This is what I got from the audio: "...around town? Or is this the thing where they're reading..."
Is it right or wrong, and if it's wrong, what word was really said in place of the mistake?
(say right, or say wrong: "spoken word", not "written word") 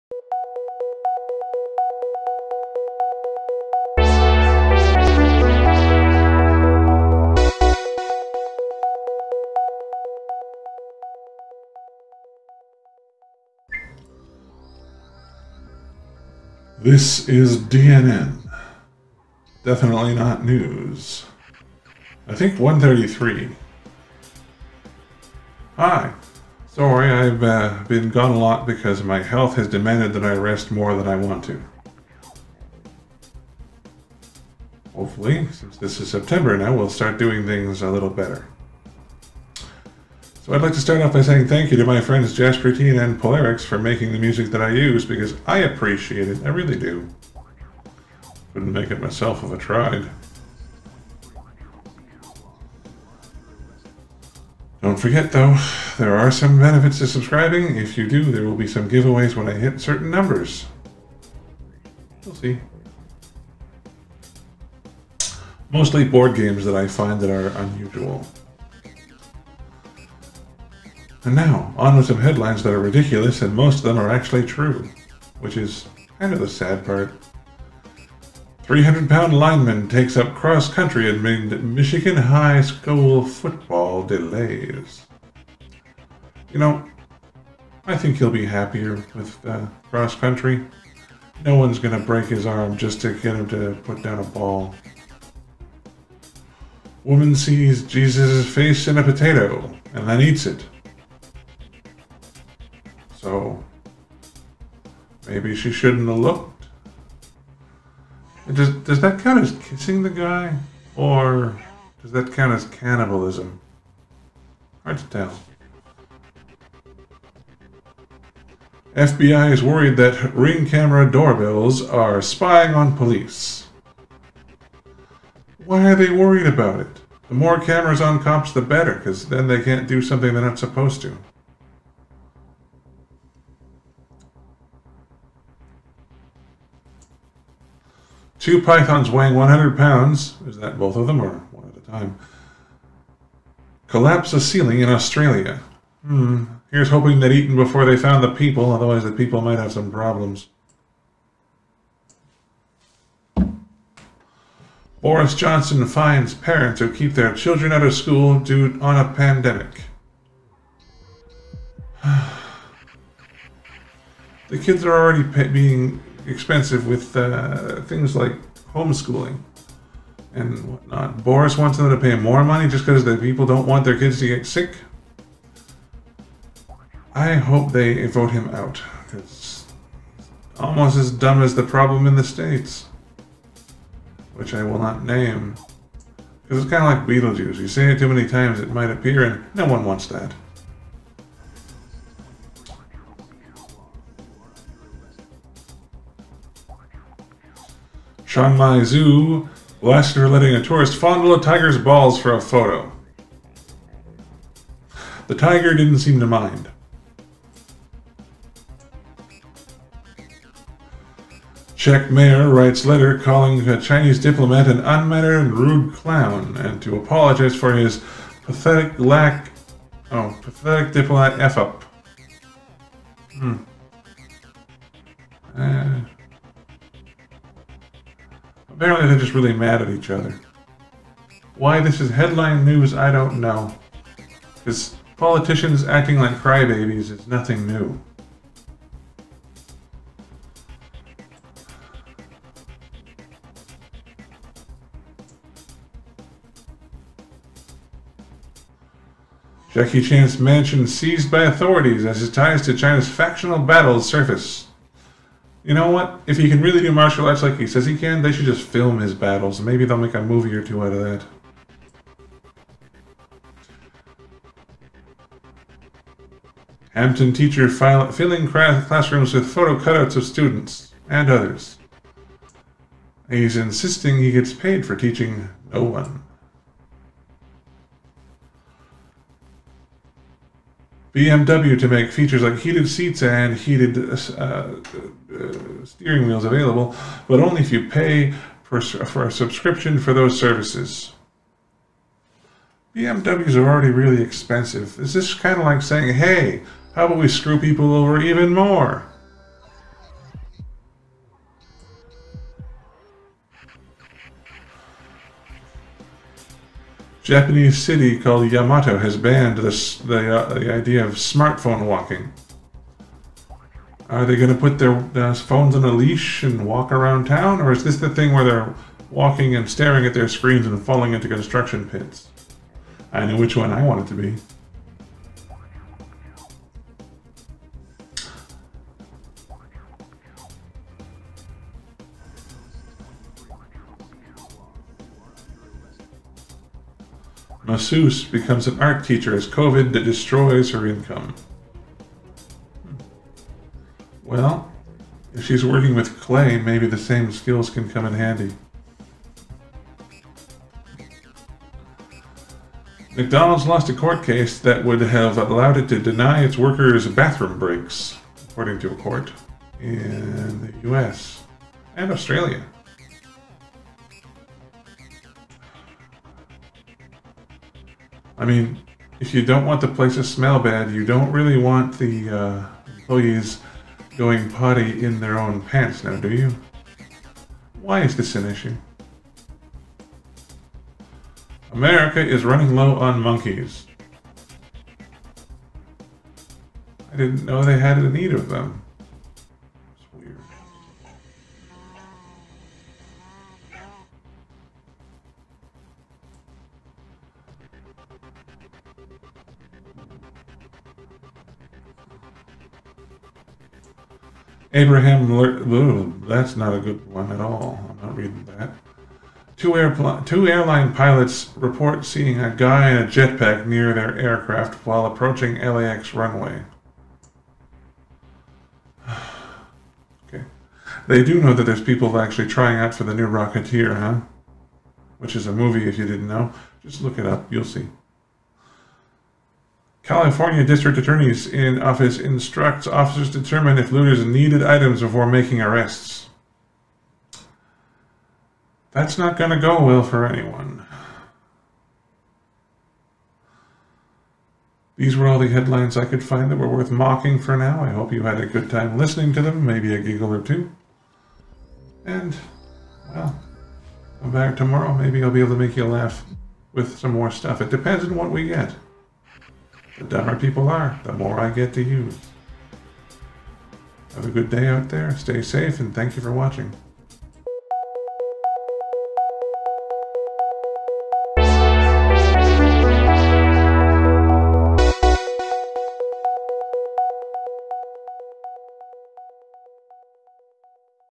wrong: "walking", not "reading".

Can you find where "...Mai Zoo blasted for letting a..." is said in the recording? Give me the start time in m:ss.
3:18.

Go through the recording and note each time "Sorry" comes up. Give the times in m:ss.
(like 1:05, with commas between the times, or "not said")
0:26.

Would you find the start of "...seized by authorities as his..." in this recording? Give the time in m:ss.
4:10.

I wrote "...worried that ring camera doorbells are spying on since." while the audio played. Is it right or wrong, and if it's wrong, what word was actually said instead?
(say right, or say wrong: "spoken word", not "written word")
wrong: "police", not "since".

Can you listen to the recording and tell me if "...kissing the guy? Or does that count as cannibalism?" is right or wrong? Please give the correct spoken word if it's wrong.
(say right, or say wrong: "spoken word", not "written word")
right.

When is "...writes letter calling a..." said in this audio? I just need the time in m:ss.
3:32.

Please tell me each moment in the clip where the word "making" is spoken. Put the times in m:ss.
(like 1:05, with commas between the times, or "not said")
0:43, 7:15.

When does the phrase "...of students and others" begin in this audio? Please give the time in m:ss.
4:30.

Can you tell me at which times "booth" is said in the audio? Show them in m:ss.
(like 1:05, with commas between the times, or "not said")
not said.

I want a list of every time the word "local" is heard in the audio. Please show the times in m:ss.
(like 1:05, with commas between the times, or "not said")
not said.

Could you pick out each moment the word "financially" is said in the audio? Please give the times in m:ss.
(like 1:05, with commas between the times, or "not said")
not said.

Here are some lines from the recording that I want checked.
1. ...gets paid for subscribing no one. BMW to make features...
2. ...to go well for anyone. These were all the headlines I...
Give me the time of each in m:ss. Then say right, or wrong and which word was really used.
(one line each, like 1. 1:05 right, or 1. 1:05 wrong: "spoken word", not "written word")
1. 4:34 wrong: "teaching", not "subscribing"
2. 7:19 right.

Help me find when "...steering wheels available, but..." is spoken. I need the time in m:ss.
4:45.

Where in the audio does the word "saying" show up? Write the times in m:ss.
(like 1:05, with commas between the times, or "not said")
0:41, 4:55.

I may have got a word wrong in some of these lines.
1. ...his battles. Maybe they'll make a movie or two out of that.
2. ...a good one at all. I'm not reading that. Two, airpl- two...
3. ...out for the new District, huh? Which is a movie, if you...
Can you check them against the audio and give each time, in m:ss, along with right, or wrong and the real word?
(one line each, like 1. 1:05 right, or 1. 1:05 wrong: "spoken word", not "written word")
1. 4:18 right
2. 6:46 right
3. 7:02 wrong: "Rocketeer", not "District".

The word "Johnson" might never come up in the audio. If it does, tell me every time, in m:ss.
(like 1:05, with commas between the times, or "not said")
2:35.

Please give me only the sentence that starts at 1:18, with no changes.
300 pound lineman takes up cross country amid Michigan high school football delays.